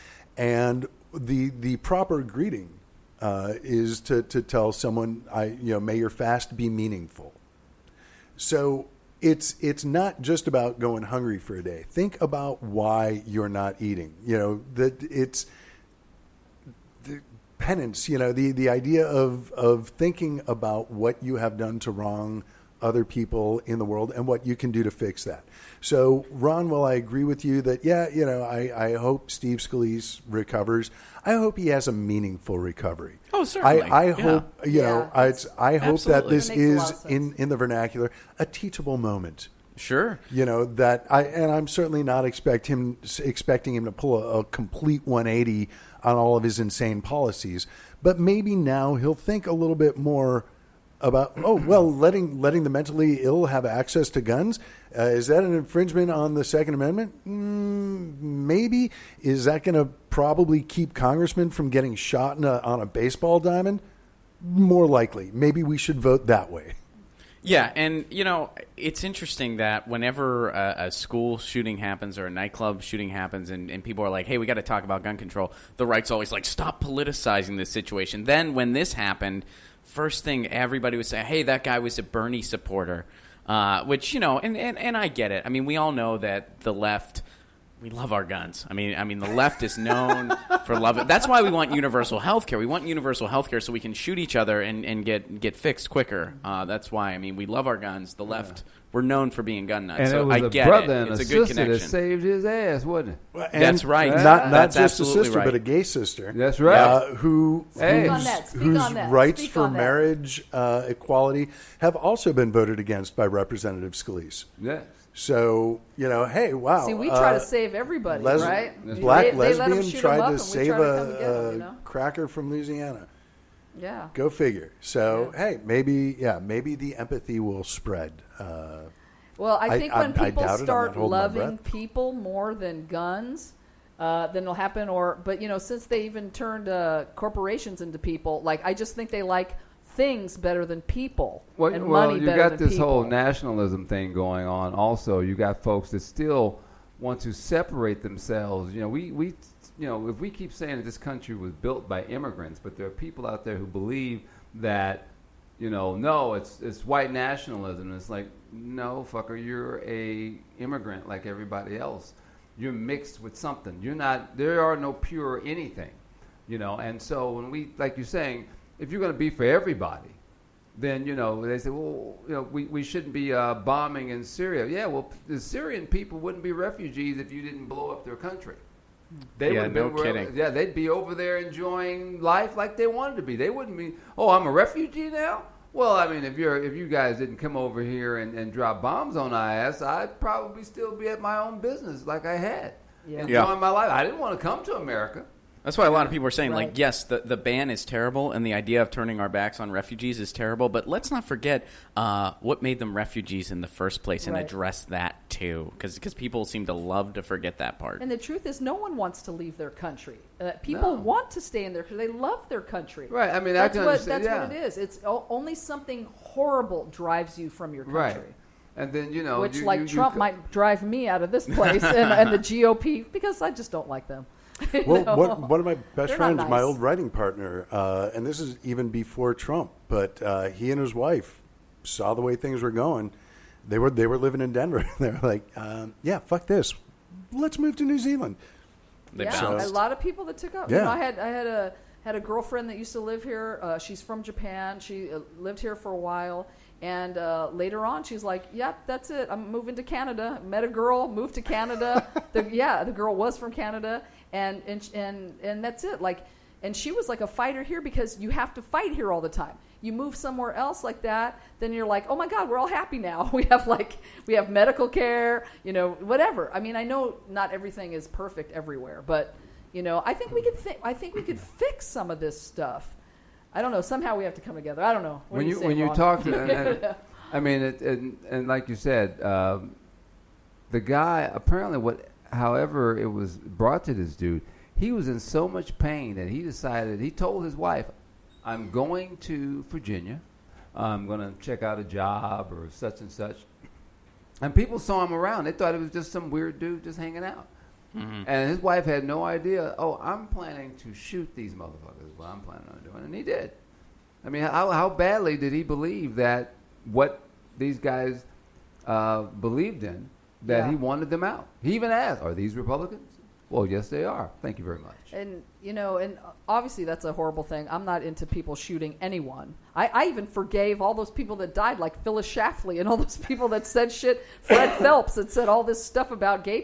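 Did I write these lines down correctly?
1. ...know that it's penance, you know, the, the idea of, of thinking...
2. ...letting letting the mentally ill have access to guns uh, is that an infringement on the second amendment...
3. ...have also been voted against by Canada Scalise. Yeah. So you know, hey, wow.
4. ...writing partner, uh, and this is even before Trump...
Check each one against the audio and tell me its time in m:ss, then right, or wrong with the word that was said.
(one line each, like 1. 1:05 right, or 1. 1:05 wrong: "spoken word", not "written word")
1. 0:14 right
2. 0:51 right
3. 1:51 wrong: "Representative", not "Canada"
4. 3:46 right.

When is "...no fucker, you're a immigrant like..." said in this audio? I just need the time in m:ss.
2:38.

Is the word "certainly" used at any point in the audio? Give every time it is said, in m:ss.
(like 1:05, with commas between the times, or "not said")
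0:33, 0:41.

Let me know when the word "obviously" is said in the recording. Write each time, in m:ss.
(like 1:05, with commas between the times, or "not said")
5:16.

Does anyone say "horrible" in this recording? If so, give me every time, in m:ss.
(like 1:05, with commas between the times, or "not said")
3:36, 5:17.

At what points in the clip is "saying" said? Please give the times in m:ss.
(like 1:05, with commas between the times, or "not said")
2:30, 2:48, 3:16.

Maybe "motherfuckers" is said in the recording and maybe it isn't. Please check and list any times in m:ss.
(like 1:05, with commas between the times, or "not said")
5:01.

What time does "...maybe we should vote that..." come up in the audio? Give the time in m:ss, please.
1:05.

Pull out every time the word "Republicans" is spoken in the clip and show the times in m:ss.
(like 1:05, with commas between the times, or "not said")
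5:12.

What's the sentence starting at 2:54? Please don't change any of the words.
Yeah, well, the Syrian people wouldn't be refugees if you didn't blow up their country.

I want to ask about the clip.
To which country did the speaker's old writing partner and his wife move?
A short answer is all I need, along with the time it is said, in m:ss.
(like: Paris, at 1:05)
New Zealand, at 3:57.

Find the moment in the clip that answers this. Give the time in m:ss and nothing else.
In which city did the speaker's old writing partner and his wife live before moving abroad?
3:54.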